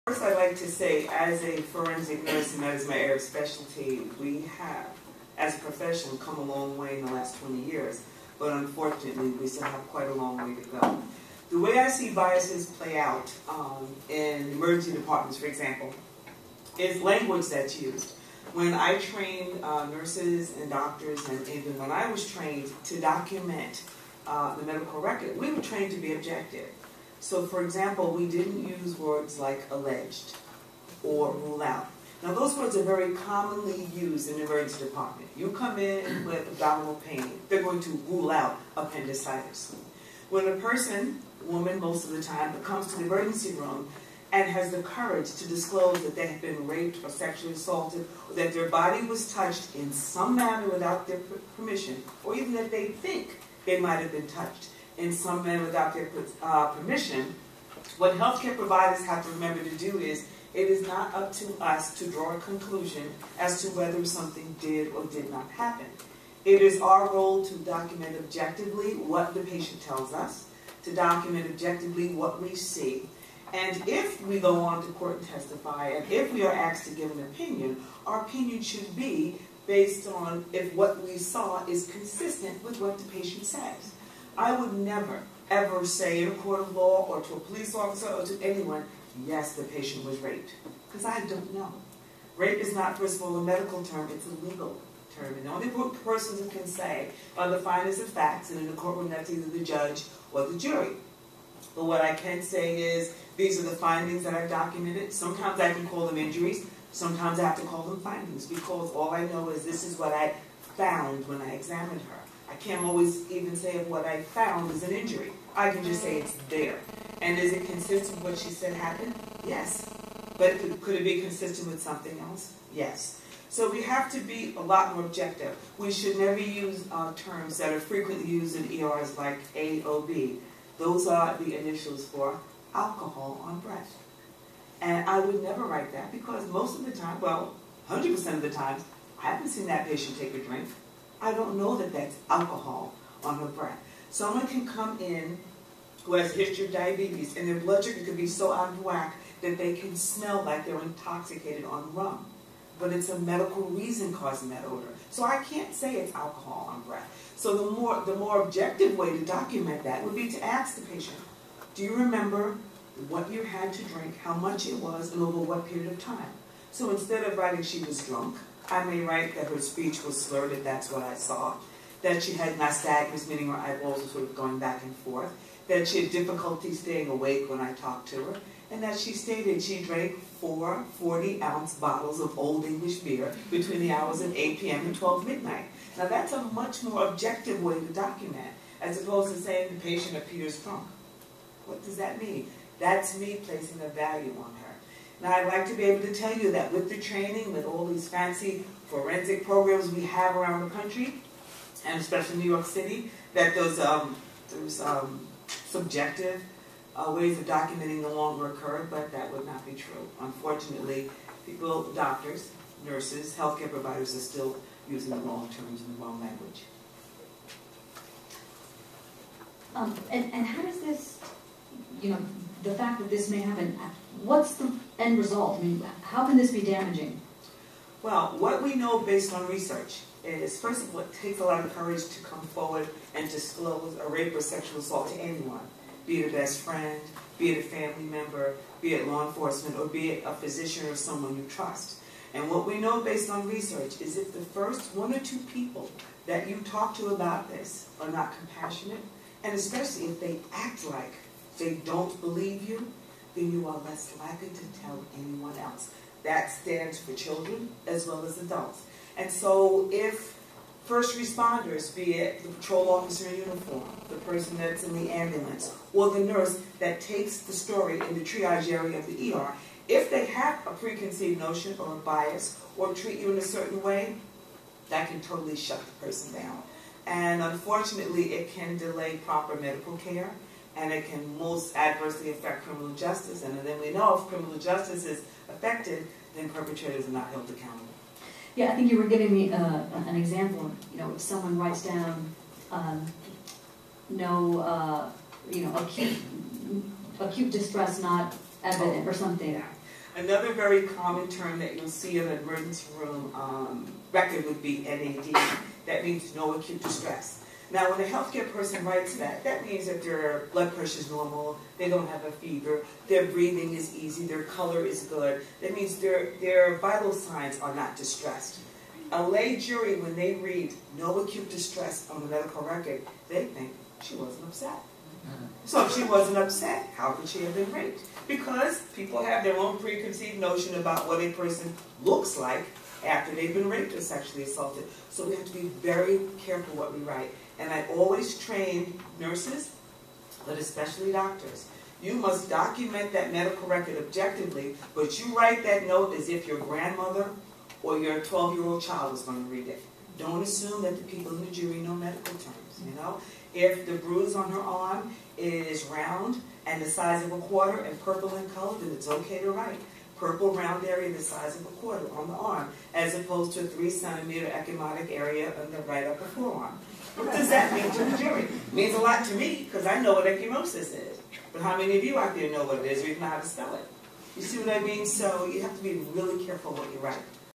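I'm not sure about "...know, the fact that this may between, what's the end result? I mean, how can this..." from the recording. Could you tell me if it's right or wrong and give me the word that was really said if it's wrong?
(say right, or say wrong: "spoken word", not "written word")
wrong: "happen", not "between".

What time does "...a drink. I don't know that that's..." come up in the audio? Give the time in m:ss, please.
2:20.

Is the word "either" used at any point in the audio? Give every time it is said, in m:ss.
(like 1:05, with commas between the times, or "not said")
1:39.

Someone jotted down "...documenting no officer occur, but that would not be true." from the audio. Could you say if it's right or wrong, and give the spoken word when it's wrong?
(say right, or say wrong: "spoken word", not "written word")
wrong: "longer", not "officer".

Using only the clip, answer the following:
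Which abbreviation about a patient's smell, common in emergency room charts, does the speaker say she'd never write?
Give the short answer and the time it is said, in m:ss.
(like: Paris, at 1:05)
AOB, at 2:09.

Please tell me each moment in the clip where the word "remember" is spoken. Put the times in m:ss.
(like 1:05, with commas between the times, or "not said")
0:59, 2:41.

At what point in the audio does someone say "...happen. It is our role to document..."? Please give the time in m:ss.
1:05.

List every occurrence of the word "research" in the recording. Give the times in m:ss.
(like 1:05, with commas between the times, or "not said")
3:49, 4:03.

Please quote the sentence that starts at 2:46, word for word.
So instead of writing she was drunk, I may write that her speech was slurred, that's what I saw.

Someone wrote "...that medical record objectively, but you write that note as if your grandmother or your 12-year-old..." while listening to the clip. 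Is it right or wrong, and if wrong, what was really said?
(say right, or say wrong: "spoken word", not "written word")
right.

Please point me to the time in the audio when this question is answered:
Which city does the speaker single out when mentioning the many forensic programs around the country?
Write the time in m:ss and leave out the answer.
3:22.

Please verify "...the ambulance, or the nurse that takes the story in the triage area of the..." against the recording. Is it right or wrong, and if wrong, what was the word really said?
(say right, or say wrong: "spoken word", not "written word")
right.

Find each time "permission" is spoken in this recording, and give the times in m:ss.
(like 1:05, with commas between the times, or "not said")
0:51, 0:56.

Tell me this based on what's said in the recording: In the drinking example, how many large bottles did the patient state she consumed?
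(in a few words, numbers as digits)
4.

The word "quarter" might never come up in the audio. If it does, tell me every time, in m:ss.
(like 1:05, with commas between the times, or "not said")
5:57, 6:01.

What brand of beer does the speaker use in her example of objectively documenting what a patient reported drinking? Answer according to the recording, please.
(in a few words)
Old English.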